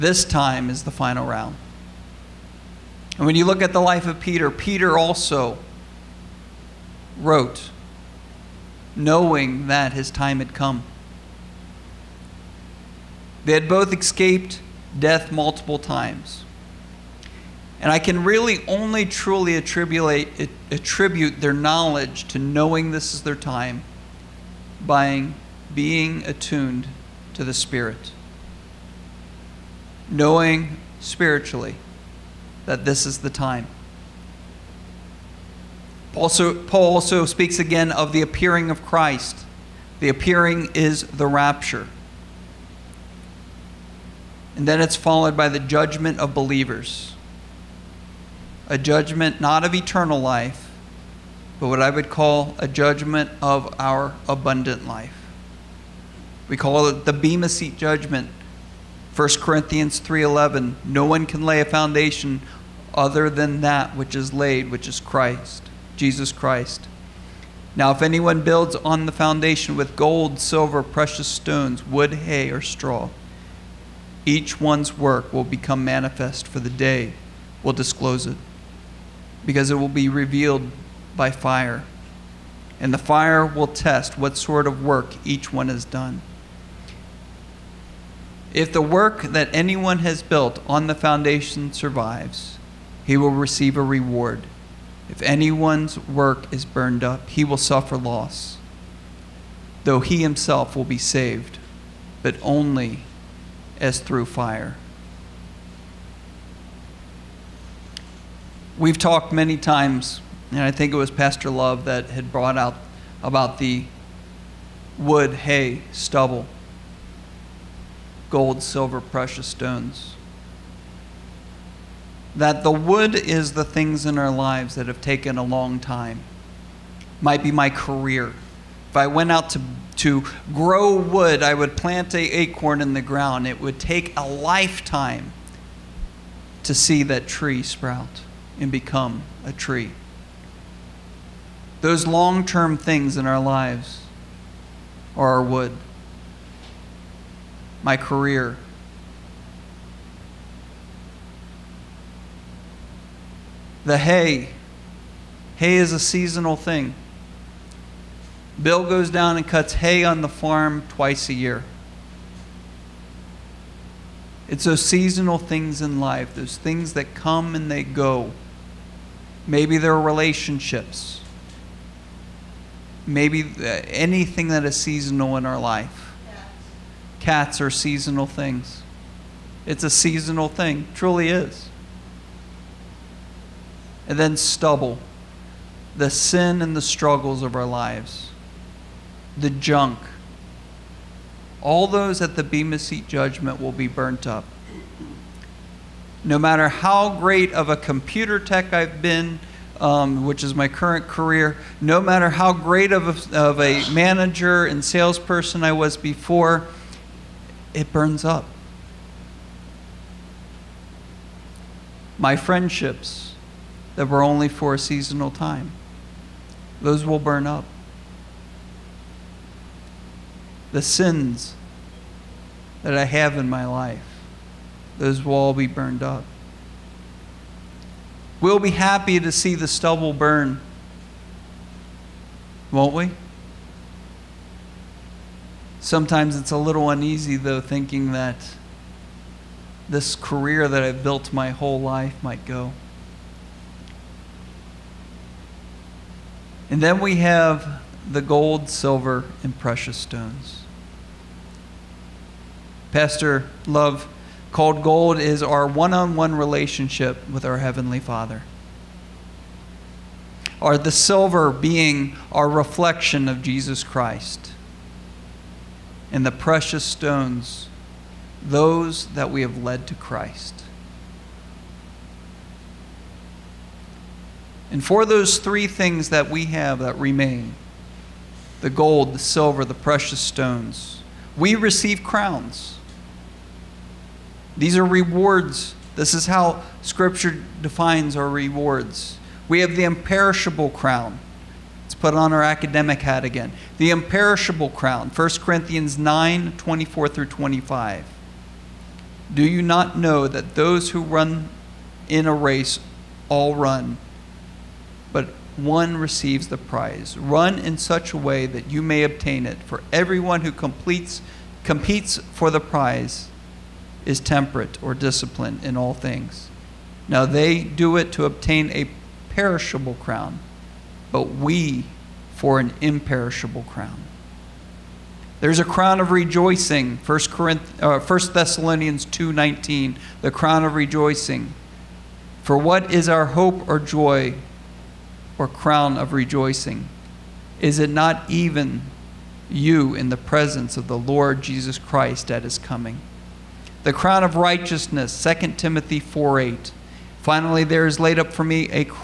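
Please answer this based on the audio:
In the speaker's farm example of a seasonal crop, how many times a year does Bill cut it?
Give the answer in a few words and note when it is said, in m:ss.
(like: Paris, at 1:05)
Twice a year, at 2:40.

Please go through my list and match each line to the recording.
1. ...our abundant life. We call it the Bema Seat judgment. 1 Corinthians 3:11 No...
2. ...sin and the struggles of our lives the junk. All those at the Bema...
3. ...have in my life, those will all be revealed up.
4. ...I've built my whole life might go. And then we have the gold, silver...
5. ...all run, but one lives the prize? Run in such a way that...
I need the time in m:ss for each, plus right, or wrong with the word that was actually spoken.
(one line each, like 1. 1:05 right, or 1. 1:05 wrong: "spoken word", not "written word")
1. 0:53 right
2. 3:06 right
3. 3:43 wrong: "burned", not "revealed"
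4. 4:00 right
5. 5:03 wrong: "receives", not "lives".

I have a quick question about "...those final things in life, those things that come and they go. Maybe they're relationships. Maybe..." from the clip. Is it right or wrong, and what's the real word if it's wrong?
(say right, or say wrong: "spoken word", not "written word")
wrong: "seasonal", not "final".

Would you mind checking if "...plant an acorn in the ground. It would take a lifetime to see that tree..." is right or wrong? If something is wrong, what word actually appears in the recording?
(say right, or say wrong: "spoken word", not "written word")
right.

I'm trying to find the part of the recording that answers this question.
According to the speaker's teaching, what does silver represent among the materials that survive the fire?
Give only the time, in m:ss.
4:22.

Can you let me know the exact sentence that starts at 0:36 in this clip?
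Also, Paul also speaks again of the appearing of Christ.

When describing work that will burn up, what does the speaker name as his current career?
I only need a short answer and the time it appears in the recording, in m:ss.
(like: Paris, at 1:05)
Computer tech, at 3:17.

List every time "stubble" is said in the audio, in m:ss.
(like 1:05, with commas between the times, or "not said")
1:55, 3:04, 3:49.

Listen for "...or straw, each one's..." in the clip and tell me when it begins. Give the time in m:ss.
1:12.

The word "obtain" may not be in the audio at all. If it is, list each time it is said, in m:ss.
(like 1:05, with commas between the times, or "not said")
5:09, 5:18.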